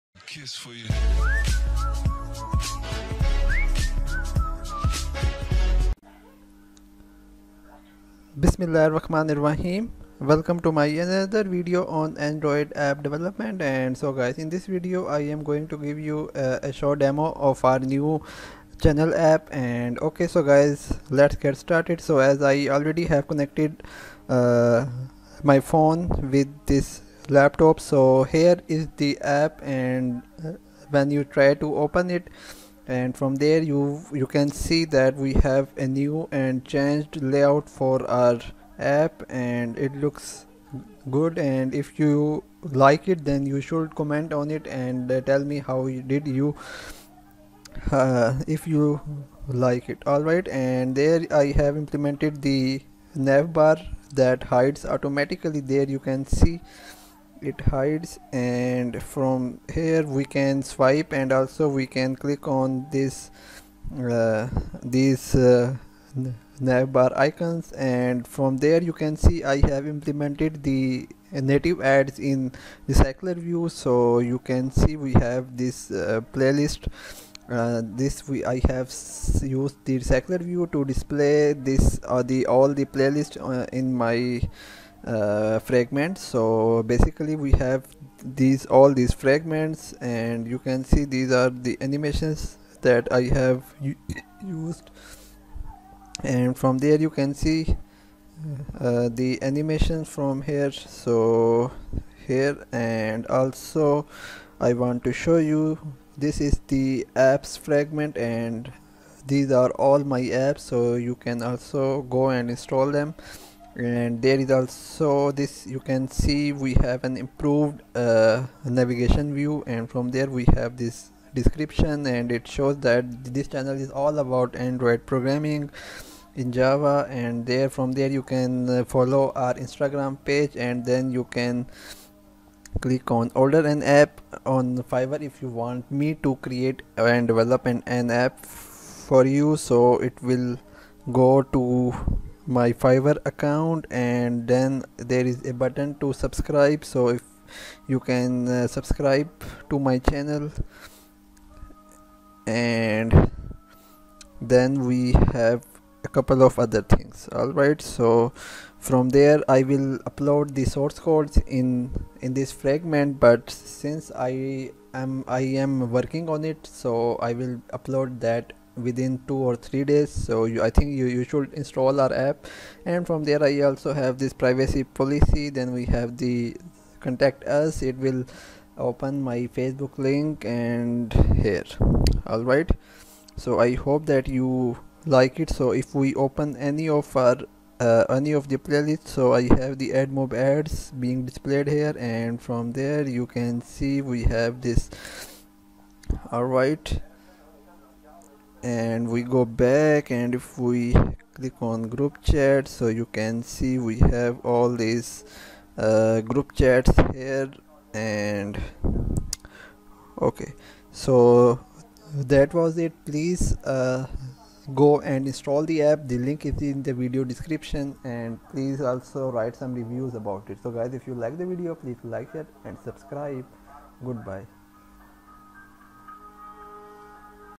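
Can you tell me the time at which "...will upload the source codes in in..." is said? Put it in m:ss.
2:39.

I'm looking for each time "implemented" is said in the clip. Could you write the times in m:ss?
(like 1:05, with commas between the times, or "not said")
0:51, 1:09.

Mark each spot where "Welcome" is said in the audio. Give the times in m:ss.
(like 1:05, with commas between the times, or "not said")
0:10.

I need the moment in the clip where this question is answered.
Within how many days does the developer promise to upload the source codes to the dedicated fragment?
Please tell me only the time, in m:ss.
2:49.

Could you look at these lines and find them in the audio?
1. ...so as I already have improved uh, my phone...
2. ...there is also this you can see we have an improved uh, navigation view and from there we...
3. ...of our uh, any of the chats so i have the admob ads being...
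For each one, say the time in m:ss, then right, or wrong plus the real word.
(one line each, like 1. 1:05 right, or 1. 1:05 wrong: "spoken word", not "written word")
1. 0:21 wrong: "connected", not "improved"
2. 1:54 right
3. 3:06 wrong: "playlists", not "chats".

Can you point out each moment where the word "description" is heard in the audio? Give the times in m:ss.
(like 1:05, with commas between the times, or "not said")
2:01, 3:37.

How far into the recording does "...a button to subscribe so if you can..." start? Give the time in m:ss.
2:25.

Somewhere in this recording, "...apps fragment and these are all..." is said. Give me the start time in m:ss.
1:47.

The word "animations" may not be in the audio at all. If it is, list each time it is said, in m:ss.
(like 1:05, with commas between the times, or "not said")
1:31, 1:39.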